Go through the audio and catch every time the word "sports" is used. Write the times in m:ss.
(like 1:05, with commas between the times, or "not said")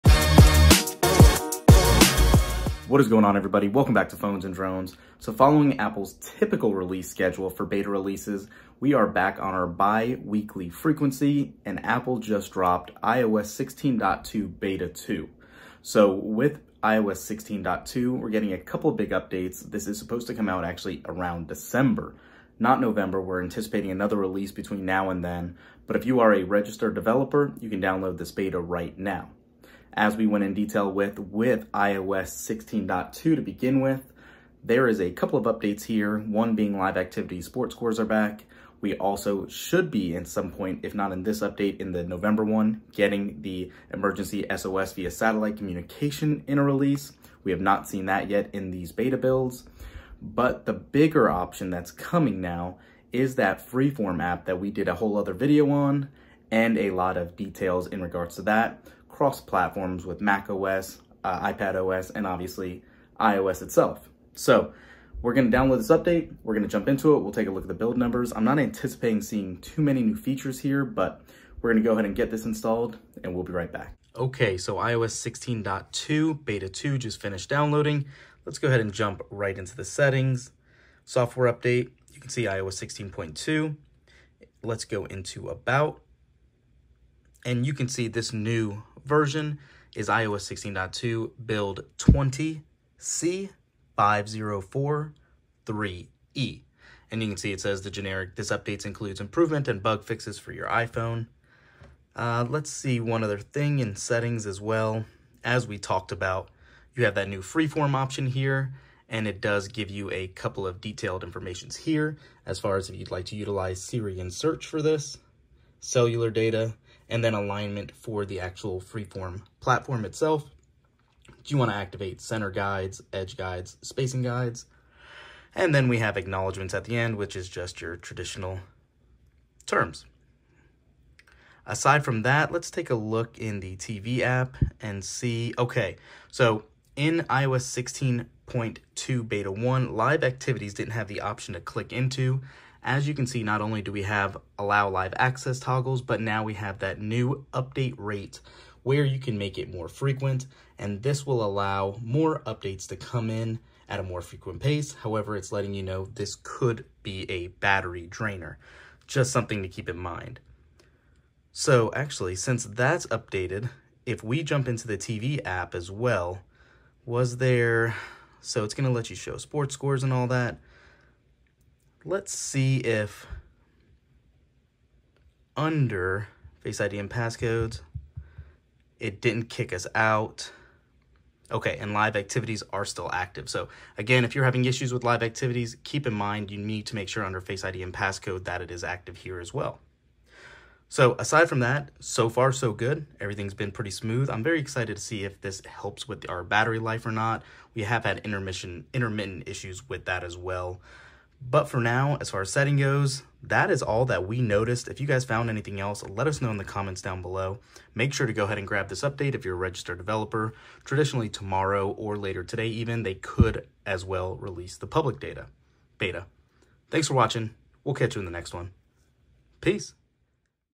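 0:37, 2:49.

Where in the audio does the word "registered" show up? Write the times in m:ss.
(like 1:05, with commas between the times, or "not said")
0:26, 3:29.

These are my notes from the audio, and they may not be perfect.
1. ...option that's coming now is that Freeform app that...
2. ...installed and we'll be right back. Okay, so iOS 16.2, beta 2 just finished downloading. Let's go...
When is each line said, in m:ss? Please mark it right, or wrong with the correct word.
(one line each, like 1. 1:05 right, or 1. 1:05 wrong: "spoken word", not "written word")
1. 0:51 right
2. 1:12 right.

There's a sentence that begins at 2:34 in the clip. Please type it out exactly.
However, it's letting you know this could be a battery drainer.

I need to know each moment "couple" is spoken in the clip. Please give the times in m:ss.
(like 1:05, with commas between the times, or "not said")
0:18, 0:35, 1:50.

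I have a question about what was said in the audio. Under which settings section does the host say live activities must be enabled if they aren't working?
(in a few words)
Face ID and passcode.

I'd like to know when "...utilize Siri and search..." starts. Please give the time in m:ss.
1:53.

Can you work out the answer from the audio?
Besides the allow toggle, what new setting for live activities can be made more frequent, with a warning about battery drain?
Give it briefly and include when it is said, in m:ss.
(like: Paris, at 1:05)
update rate, at 2:27.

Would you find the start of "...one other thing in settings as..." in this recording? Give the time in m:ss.
1:43.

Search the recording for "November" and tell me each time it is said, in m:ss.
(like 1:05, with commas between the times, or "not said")
0:22, 0:42.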